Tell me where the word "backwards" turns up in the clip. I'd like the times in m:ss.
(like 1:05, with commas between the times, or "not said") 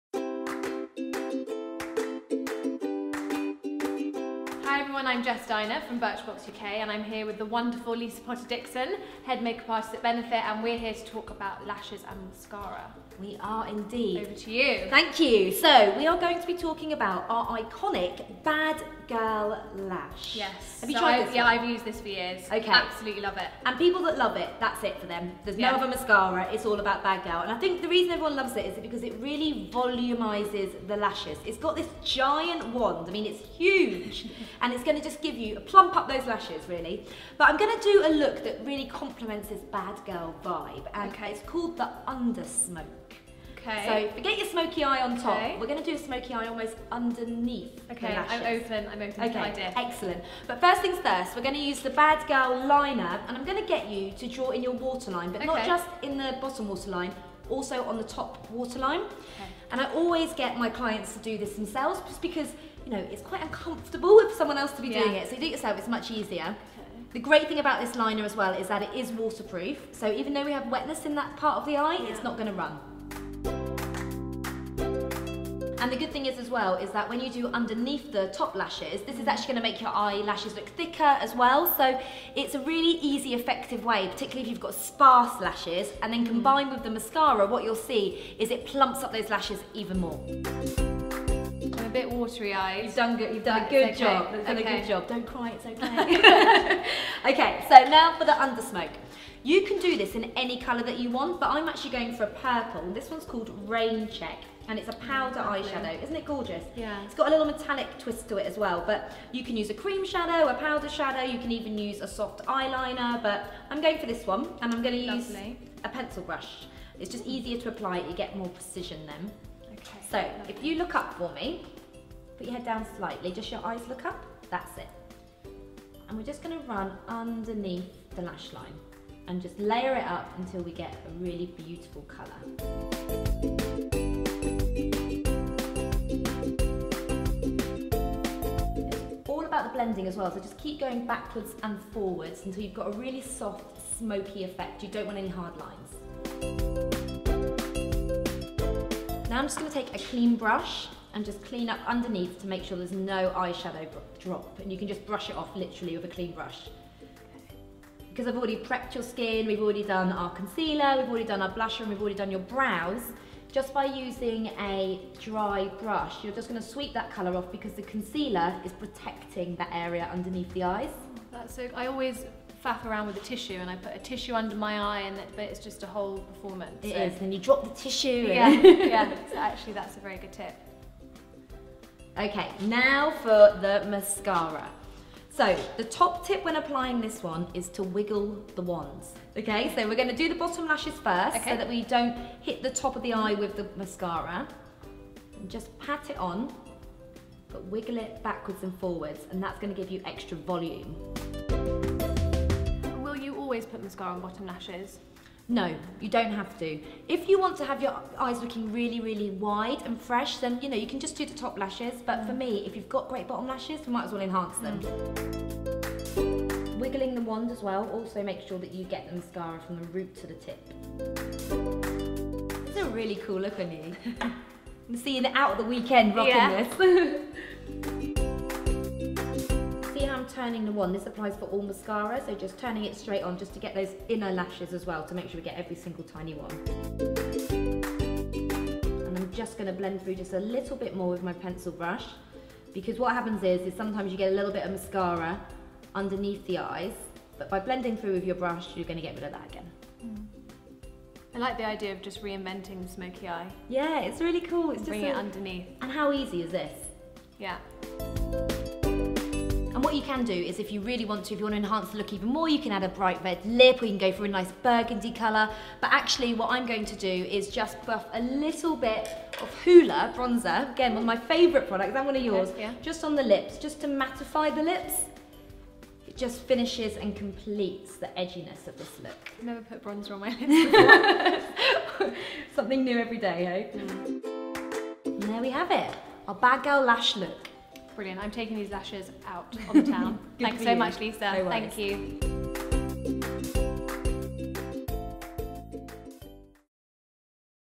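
2:21, 3:18.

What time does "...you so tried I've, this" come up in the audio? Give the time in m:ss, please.
0:20.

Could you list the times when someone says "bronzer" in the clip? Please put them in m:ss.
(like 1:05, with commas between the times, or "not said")
4:30, 4:39.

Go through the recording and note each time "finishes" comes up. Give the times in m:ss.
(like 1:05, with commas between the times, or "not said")
4:36.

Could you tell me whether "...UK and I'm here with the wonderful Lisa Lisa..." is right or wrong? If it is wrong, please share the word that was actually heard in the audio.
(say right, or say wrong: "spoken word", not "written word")
wrong: "Potter", not "Lisa".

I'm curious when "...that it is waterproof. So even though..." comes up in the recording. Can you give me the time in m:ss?
1:08.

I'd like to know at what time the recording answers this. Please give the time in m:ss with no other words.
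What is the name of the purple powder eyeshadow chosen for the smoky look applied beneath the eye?
1:43.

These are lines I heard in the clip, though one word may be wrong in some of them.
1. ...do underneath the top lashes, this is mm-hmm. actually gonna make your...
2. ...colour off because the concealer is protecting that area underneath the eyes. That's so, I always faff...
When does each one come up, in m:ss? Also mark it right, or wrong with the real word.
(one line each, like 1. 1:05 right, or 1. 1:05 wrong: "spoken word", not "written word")
1. 1:17 right
2. 2:47 right.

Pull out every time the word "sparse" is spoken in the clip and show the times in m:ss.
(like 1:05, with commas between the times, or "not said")
1:24.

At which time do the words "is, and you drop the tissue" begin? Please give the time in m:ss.
2:57.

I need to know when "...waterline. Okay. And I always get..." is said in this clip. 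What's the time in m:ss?
0:58.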